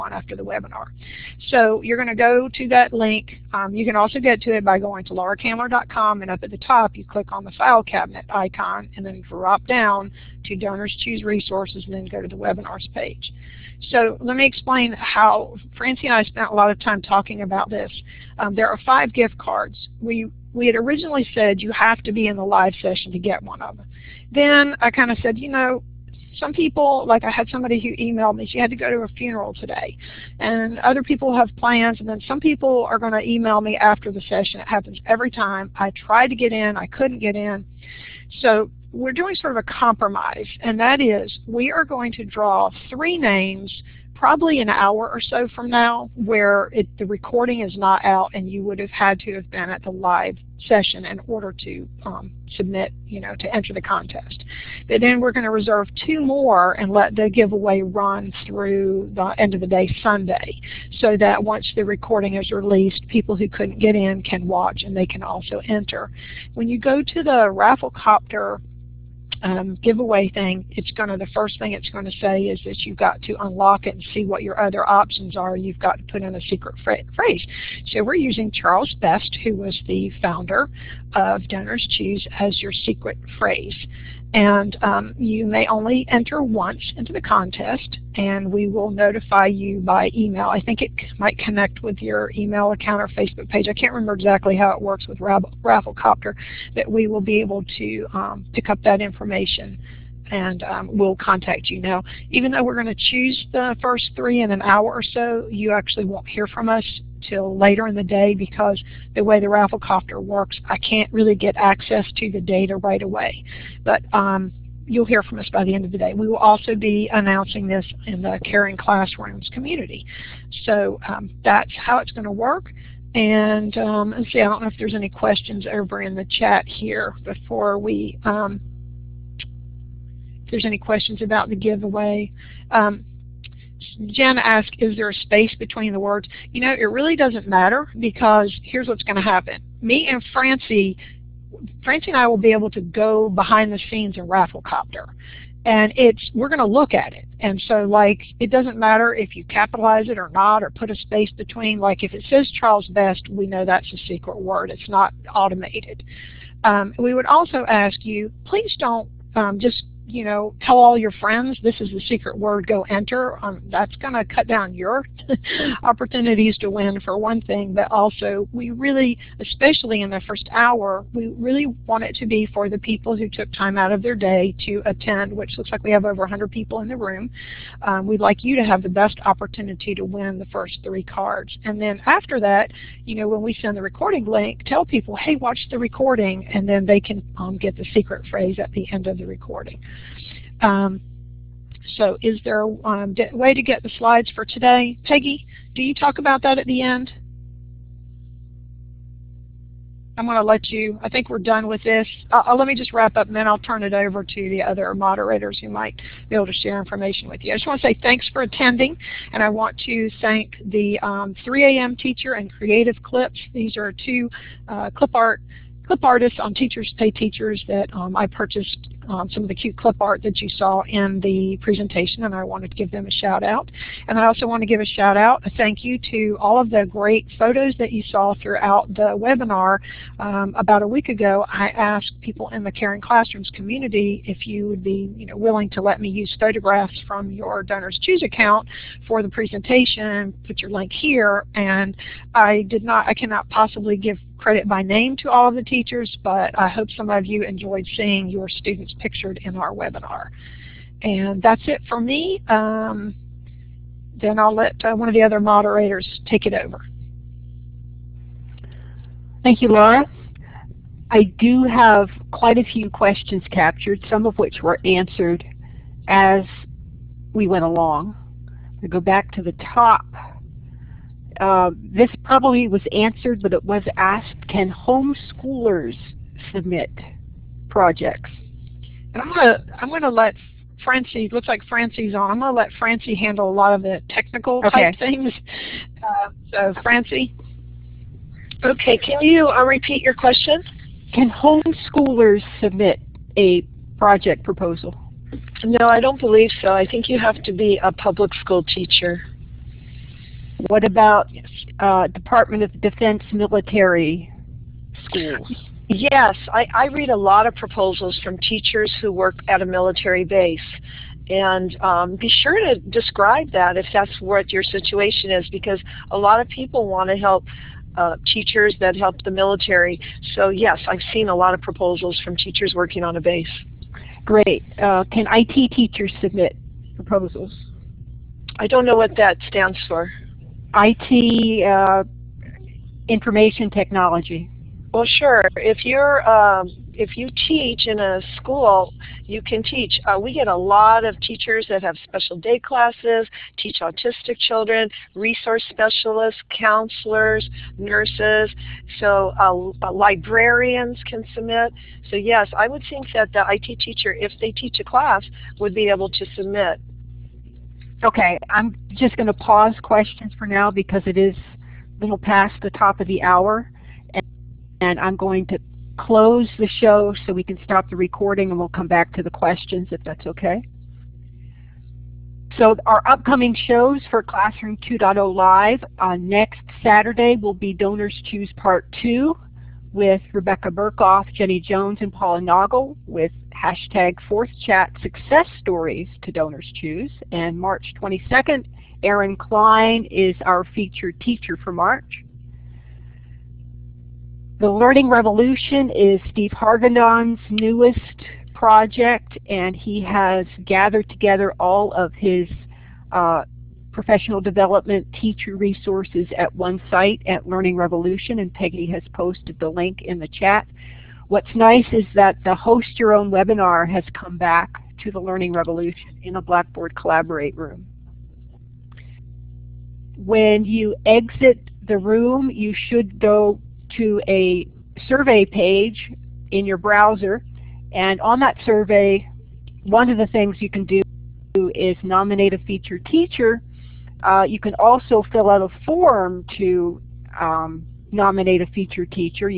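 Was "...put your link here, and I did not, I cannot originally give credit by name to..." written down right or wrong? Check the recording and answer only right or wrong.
wrong.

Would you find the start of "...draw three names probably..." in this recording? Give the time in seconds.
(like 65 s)
42 s.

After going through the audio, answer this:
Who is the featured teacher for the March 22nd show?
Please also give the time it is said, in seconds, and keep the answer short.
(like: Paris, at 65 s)
Erin Klein, at 389 s.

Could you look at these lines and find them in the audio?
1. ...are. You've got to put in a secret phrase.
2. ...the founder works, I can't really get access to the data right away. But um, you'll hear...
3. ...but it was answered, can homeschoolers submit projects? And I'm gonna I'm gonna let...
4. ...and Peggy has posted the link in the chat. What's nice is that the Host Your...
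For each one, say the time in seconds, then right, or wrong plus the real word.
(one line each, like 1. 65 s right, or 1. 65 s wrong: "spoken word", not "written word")
1. 75 s right
2. 109 s wrong: "rafflecopter", not "founder"
3. 273 s wrong: "asked", not "answered"
4. 408 s right.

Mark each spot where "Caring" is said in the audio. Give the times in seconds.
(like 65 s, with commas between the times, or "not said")
118 s, 232 s.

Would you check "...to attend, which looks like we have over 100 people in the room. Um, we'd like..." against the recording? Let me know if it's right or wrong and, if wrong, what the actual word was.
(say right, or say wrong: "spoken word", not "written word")
right.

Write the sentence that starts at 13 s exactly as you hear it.
So let me explain how Francie and I spent a lot of time talking about this.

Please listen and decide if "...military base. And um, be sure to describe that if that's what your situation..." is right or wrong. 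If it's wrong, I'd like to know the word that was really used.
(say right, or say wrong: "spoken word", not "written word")
right.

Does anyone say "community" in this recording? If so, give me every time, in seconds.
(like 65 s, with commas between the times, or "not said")
119 s, 233 s.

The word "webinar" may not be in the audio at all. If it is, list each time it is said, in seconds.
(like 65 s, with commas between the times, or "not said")
0 s, 12 s, 229 s, 249 s, 413 s.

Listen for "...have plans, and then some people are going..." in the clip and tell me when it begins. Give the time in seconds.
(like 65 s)
31 s.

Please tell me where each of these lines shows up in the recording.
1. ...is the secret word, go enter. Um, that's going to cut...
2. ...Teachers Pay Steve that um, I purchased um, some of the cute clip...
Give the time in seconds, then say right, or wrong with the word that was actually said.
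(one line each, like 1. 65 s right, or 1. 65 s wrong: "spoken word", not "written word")
1. 161 s right
2. 216 s wrong: "Teachers", not "Steve".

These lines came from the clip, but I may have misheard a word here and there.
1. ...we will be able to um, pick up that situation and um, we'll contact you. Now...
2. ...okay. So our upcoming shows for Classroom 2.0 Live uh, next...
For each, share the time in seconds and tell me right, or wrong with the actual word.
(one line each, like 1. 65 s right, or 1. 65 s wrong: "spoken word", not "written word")
1. 96 s wrong: "information", not "situation"
2. 370 s right.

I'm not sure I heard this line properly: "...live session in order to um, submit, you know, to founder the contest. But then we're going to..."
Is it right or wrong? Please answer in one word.
wrong.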